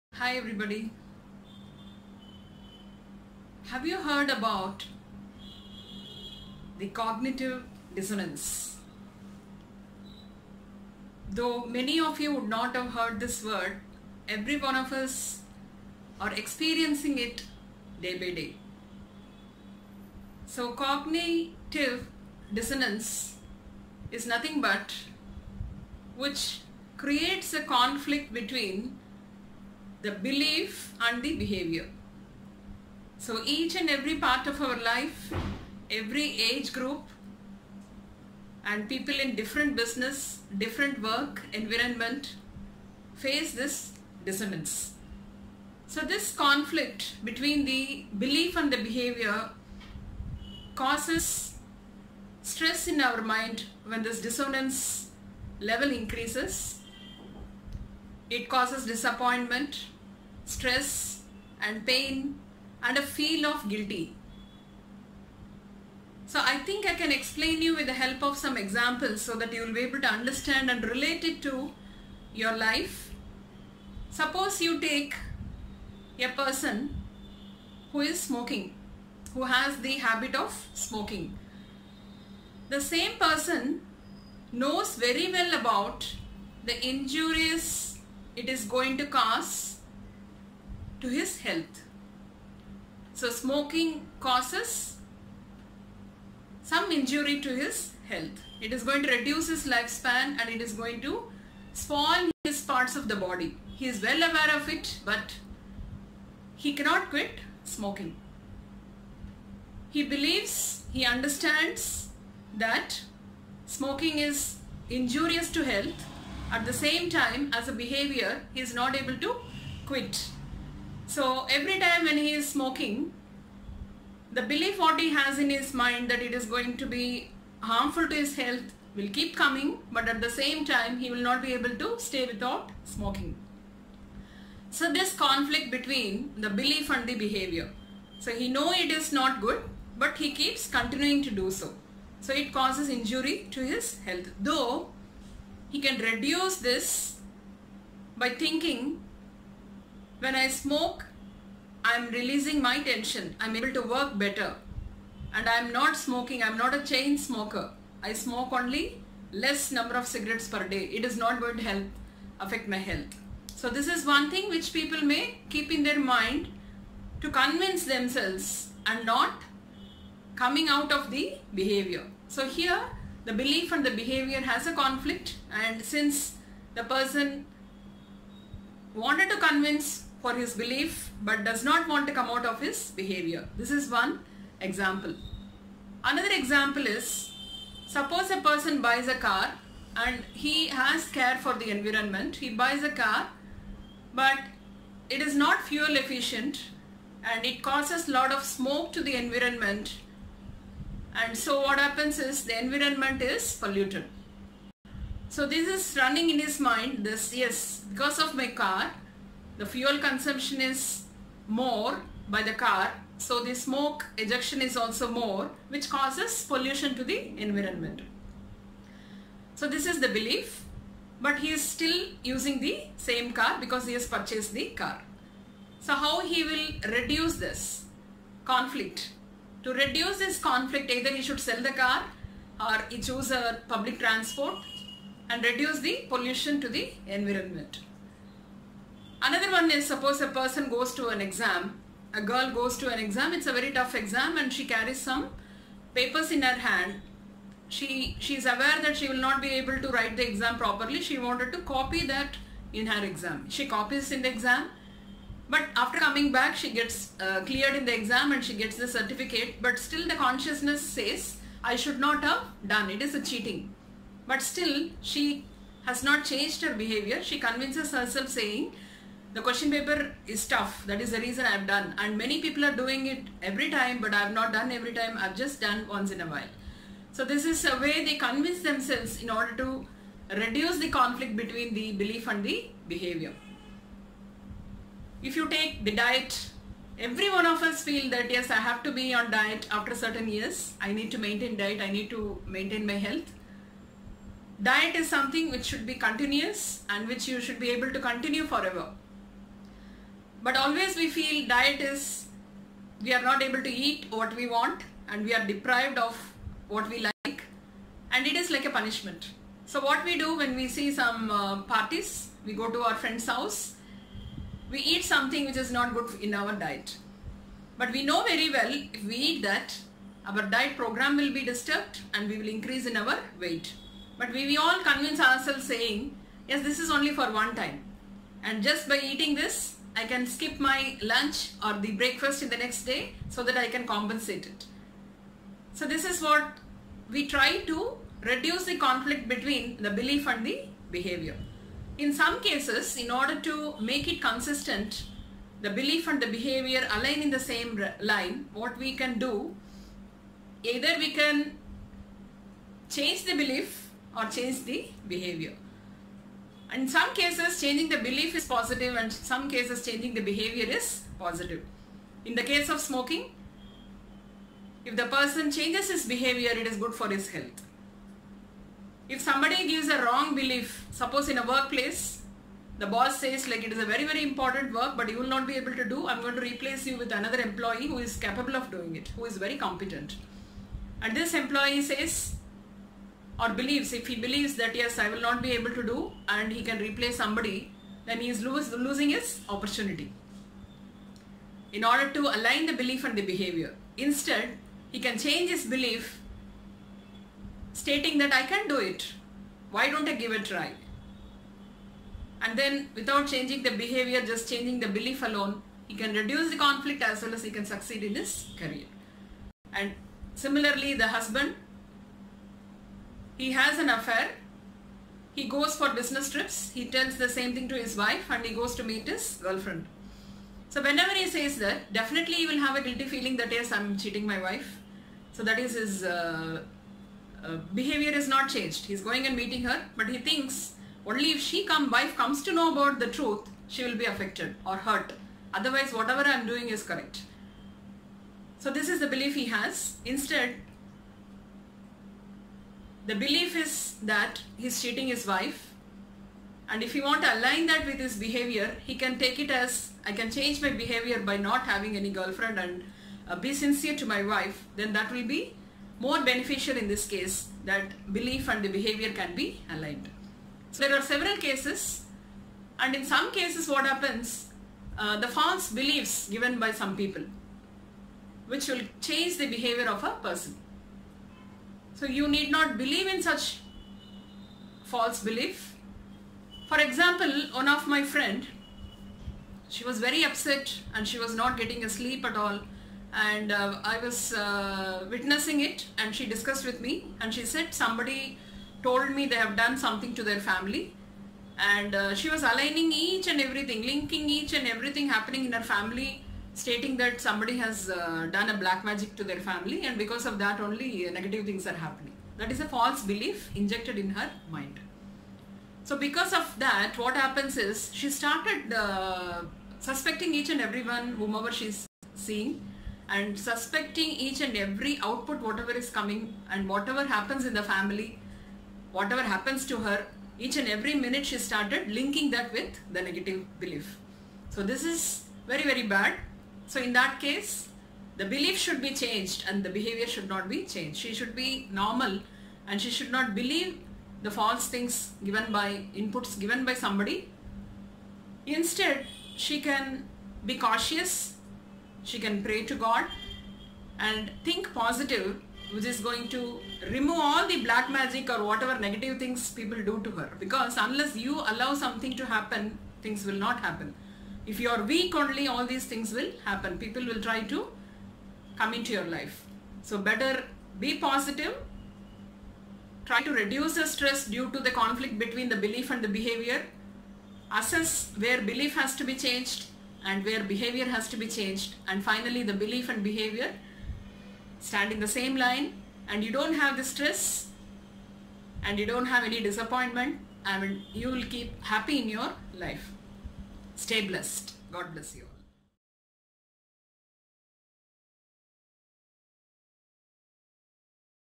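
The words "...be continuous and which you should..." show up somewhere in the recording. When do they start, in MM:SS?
04:55.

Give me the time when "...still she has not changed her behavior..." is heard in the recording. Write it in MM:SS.
04:24.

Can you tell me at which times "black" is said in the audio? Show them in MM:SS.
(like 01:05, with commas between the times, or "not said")
08:18, 09:07.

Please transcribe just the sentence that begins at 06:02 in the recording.
In the case of smoking, if the person changes his behavior, it is good for his health.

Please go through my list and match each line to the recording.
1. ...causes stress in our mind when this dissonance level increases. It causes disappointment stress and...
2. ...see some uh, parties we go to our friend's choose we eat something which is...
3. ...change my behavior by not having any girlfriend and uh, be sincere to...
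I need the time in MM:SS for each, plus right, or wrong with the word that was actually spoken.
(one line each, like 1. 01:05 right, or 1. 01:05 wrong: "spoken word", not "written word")
1. 00:50 right
2. 05:10 wrong: "house", not "choose"
3. 07:30 right.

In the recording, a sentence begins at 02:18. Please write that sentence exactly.
So he know it is not good but he keeps continuing to do so.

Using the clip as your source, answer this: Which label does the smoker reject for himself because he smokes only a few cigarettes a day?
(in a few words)
chain smoker.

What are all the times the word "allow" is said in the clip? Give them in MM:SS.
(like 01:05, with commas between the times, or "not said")
09:11.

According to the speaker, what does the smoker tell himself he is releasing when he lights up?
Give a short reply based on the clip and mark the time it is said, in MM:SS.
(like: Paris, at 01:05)
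tension, at 02:32.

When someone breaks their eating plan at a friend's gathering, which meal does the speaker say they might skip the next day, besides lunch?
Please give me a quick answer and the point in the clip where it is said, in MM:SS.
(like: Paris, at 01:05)
breakfast, at 05:31.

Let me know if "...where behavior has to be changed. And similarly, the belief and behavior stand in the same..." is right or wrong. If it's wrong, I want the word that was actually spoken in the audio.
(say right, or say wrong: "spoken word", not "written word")
wrong: "finally", not "similarly".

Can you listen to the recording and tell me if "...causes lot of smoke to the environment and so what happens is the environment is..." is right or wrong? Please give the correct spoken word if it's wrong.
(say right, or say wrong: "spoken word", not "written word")
right.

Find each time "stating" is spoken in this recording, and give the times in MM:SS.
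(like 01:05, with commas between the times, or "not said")
06:37, 08:16.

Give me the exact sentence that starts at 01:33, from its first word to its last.
So smoking causes some injury to his health.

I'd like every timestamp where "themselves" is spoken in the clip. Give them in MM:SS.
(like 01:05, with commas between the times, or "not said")
02:47, 04:38.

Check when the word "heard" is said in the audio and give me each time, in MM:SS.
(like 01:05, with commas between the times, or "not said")
00:04, 00:12.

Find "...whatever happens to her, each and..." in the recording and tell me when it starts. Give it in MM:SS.
08:38.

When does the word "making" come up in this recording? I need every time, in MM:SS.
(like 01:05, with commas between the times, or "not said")
not said.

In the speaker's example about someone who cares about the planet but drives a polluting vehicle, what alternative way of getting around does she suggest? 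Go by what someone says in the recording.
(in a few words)
public transport.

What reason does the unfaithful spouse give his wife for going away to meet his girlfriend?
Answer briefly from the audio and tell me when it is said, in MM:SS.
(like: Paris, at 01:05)
business trips, at 06:55.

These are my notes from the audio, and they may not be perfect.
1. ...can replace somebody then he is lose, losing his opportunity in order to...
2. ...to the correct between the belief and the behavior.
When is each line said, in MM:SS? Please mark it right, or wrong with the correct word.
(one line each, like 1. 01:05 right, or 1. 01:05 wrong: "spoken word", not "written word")
1. 06:26 right
2. 09:24 wrong: "conflict", not "correct".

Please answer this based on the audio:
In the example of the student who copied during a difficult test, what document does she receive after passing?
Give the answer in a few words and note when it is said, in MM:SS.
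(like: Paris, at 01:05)
certificate, at 04:18.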